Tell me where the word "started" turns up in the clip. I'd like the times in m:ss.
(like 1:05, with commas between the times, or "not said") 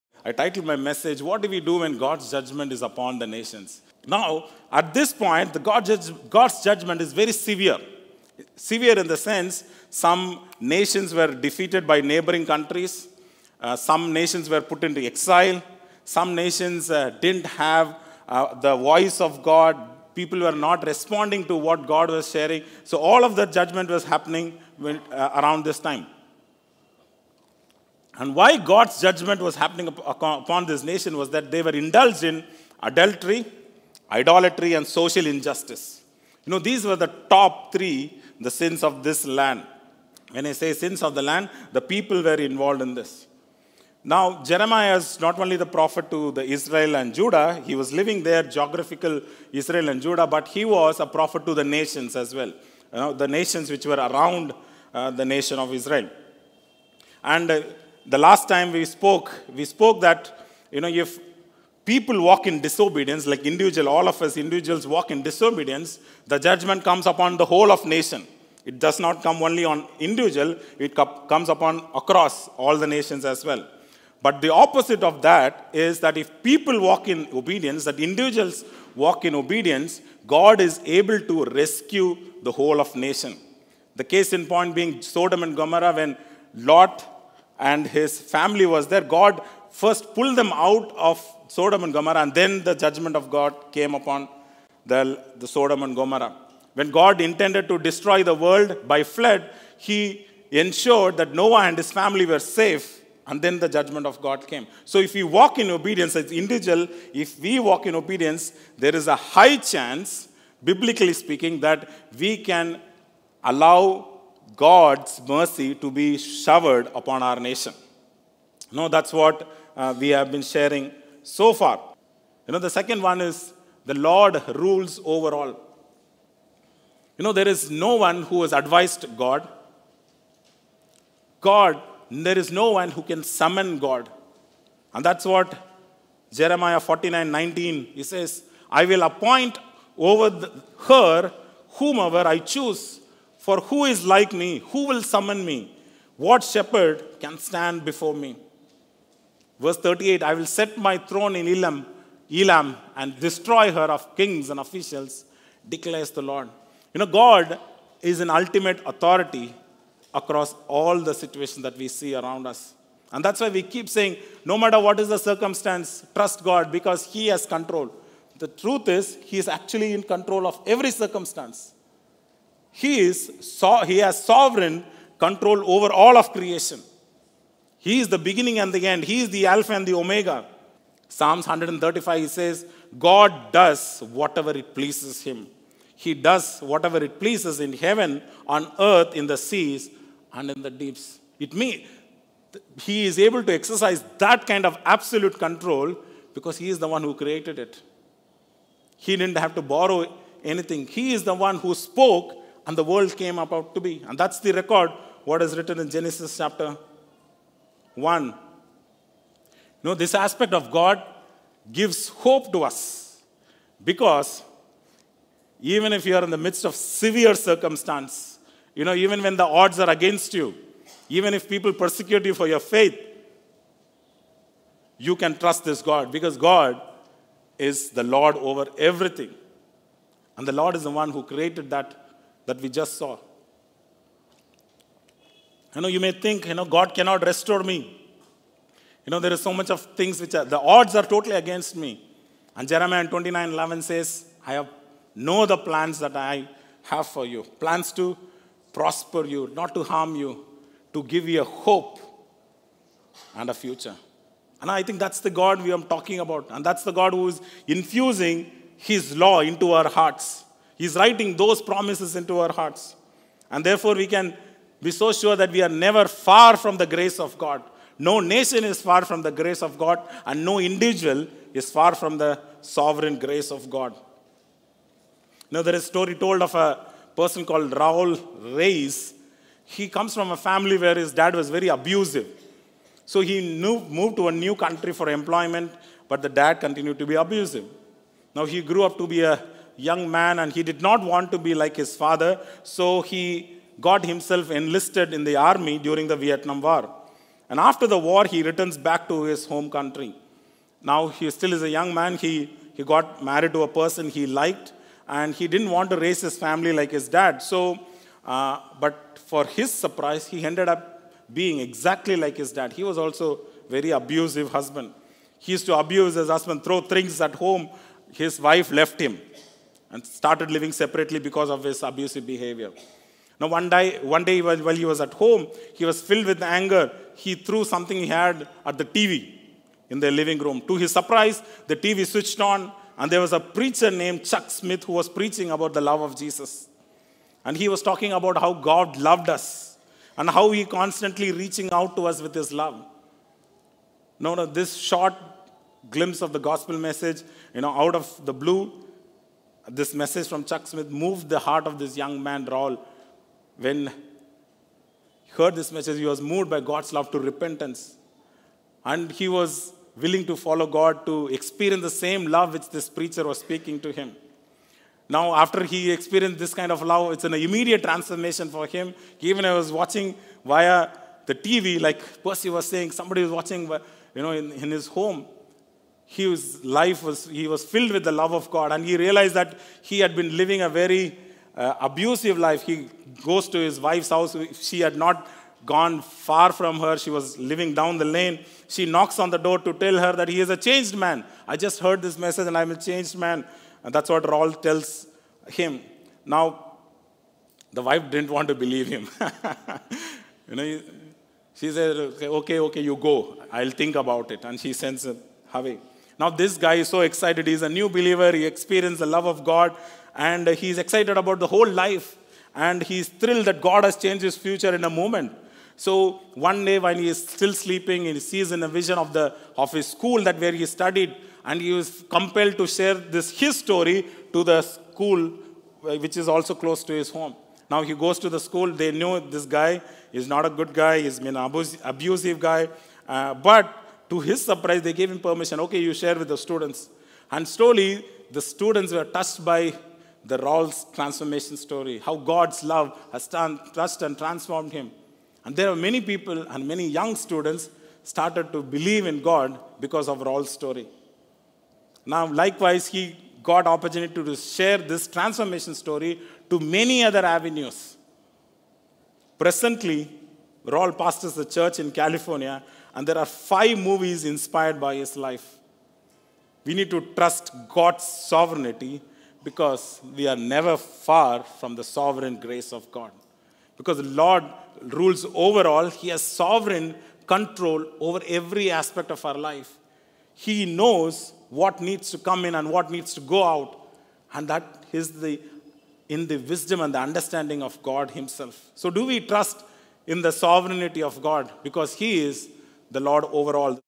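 5:20, 7:28.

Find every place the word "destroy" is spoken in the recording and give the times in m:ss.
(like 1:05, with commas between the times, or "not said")
1:37, 2:33.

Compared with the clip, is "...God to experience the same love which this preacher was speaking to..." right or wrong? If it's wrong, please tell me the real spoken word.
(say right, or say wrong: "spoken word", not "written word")
right.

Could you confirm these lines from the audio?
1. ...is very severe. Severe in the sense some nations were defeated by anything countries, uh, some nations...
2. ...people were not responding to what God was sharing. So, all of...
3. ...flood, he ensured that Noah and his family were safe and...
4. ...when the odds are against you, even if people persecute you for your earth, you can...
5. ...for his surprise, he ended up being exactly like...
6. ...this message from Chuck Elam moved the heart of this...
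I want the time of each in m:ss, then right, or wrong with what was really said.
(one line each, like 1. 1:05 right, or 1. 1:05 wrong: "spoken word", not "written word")
1. 0:07 wrong: "neighboring", not "anything"
2. 0:20 right
3. 1:39 right
4. 3:39 wrong: "faith", not "earth"
5. 5:09 right
6. 5:49 wrong: "Smith", not "Elam".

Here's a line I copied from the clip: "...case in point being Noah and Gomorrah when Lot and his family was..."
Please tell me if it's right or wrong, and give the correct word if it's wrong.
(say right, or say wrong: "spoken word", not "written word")
wrong: "Sodom", not "Noah".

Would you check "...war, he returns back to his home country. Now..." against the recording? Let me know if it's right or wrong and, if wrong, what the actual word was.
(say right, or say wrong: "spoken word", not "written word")
right.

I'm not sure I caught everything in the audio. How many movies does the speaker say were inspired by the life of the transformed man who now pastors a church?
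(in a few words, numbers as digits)
5.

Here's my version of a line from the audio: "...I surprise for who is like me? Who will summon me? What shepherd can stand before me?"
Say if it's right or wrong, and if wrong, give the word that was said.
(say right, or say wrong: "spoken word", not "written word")
wrong: "choose", not "surprise".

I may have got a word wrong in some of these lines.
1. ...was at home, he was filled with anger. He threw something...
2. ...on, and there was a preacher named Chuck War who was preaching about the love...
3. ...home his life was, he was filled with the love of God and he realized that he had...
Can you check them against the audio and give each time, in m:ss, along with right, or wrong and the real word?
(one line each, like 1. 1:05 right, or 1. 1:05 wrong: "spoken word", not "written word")
1. 5:24 right
2. 5:32 wrong: "Smith", not "War"
3. 6:14 right.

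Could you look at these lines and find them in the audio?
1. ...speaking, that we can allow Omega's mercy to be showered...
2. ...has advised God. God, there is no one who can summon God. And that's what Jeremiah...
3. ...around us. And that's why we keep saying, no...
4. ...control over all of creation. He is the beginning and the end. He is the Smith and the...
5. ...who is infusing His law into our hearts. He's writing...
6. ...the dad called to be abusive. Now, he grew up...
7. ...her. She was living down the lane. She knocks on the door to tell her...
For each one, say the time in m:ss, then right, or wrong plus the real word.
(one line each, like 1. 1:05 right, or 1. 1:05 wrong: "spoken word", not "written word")
1. 1:51 wrong: "God", not "Omega"
2. 2:08 right
3. 2:42 right
4. 2:55 wrong: "Alpha", not "Smith"
5. 4:17 right
6. 4:46 wrong: "continued", not "called"
7. 6:26 right.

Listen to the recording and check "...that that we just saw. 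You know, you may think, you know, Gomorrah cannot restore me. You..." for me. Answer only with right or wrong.
wrong.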